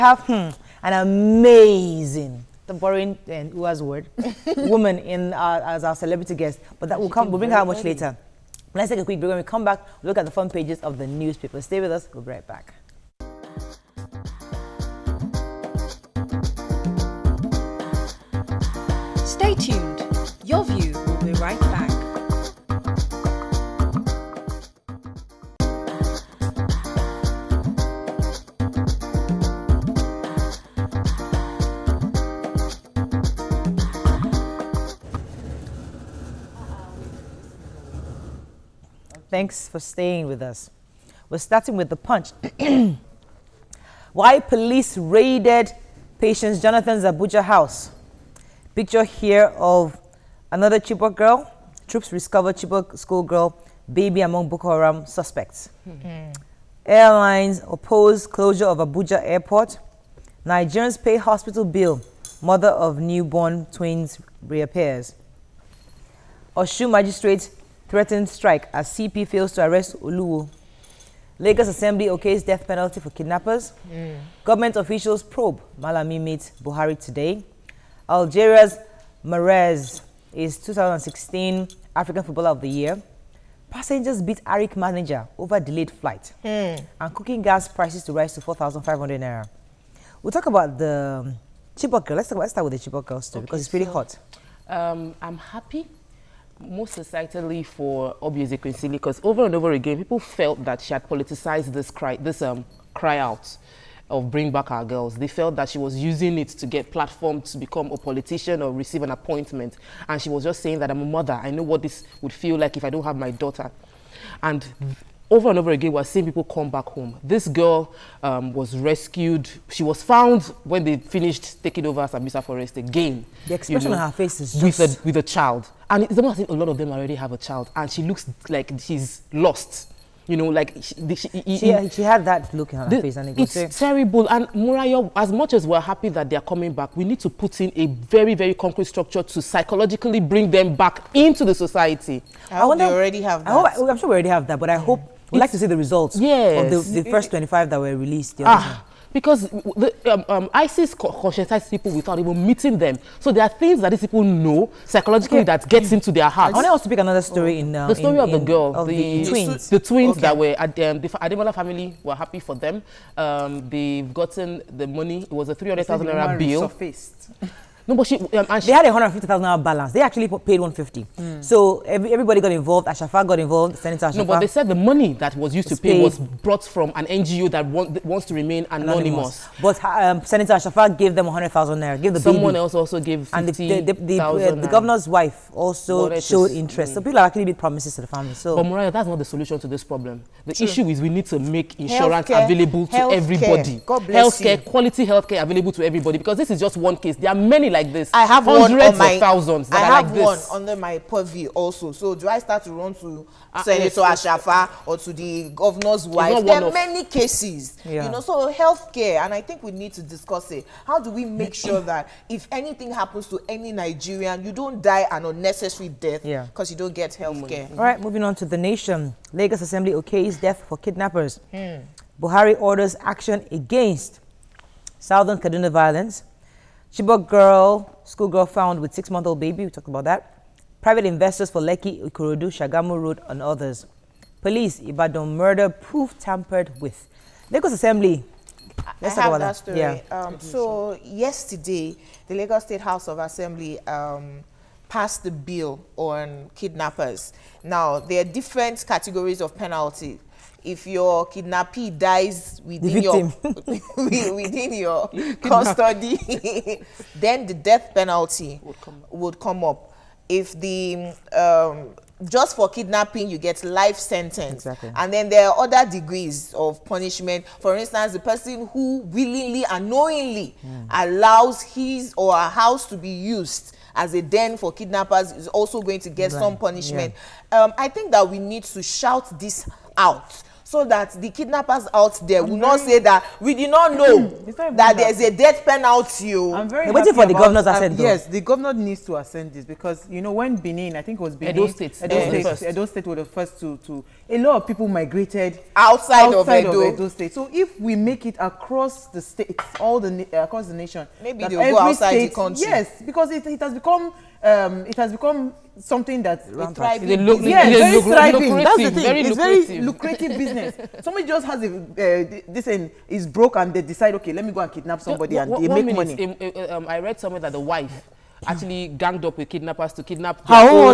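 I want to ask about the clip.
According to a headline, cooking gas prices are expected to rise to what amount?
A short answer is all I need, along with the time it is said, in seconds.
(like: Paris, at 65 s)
4,500 naira, at 88 s.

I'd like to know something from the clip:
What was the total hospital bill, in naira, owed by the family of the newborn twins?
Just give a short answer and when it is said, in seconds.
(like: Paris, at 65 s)
300,000 naira, at 165 s.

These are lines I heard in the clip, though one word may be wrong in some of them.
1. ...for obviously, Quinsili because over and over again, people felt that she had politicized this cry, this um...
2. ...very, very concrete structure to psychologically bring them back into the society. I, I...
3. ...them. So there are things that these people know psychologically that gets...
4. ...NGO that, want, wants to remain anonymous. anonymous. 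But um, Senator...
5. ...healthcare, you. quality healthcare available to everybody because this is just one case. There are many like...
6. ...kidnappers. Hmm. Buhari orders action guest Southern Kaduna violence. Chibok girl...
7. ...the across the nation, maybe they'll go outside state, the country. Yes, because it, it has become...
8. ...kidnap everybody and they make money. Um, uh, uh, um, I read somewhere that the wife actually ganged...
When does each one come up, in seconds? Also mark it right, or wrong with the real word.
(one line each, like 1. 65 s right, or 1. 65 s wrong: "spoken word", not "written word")
1. 97 s right
2. 137 s right
3. 152 s right
4. 177 s right
5. 194 s right
6. 220 s wrong: "against", not "guest"
7. 299 s right
8. 314 s wrong: "somebody", not "everybody".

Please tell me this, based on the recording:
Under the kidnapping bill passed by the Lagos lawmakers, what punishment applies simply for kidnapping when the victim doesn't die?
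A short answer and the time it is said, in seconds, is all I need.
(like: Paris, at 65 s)
Life sentence, at 263 s.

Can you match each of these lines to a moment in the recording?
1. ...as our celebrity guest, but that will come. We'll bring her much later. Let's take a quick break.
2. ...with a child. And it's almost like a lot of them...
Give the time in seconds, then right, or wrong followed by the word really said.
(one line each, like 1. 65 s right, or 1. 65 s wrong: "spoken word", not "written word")
1. 5 s right
2. 125 s right.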